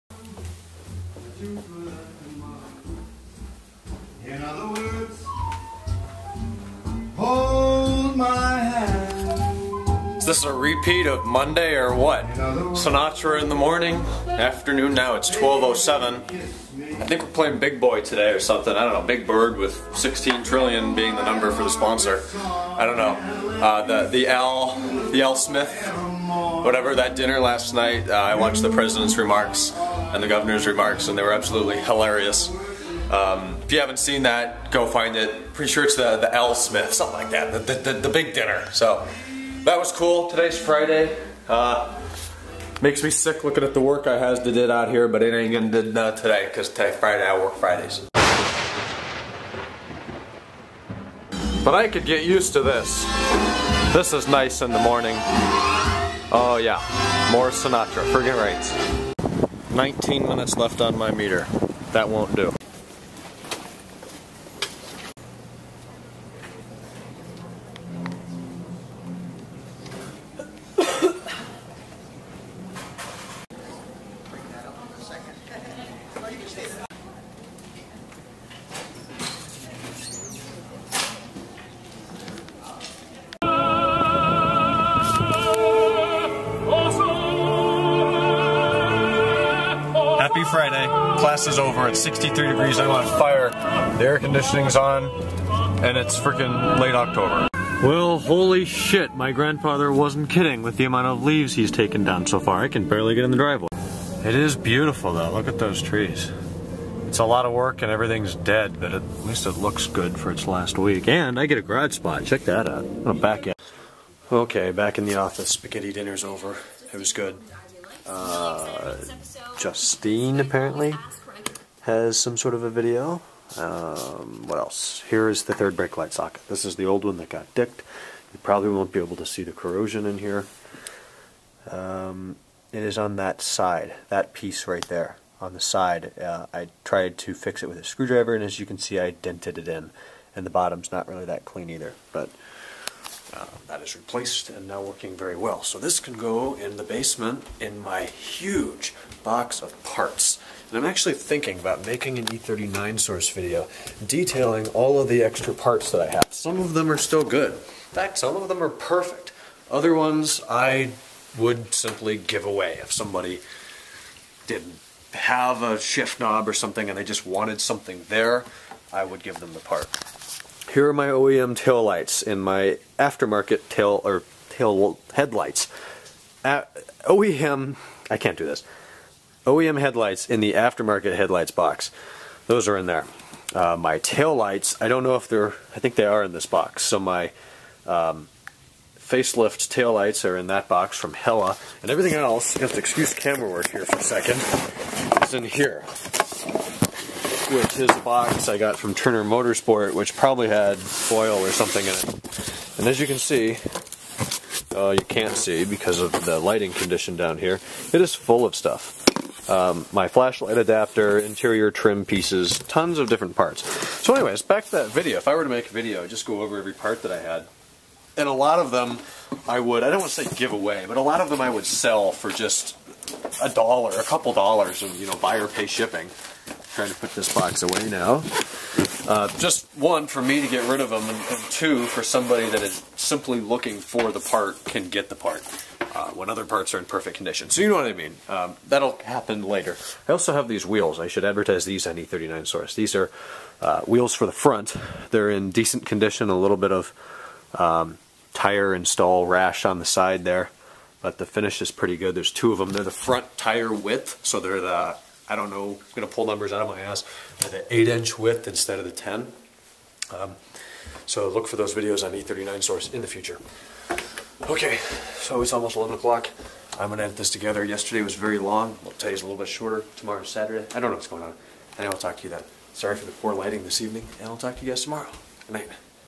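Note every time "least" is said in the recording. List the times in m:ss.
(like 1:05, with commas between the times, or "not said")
1:49.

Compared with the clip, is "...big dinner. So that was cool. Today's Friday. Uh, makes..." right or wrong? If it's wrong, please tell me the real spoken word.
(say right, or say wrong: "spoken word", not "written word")
right.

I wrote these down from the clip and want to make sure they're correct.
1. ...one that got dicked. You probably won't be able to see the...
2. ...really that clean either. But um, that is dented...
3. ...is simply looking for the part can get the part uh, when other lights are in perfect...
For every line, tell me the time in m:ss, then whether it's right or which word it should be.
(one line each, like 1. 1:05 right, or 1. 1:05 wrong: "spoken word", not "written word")
1. 2:07 right
2. 2:21 wrong: "replaced", not "dented"
3. 3:52 wrong: "parts", not "lights".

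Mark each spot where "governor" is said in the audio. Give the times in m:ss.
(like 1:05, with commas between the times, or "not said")
0:30.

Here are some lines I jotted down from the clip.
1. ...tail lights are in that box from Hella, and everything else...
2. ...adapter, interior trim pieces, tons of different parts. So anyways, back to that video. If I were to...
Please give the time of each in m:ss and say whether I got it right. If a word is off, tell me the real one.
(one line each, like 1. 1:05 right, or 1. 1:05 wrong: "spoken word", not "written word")
1. 3:09 right
2. 3:30 right.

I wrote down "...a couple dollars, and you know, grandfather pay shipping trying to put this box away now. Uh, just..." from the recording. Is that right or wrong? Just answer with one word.
wrong.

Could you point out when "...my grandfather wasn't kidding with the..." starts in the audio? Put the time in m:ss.
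1:39.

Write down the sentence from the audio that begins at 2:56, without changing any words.
Uh, OEM, I can't do this.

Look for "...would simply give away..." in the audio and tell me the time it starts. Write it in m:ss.
2:41.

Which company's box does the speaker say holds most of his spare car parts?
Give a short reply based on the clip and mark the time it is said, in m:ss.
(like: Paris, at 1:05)
Turner Motorsport, at 3:18.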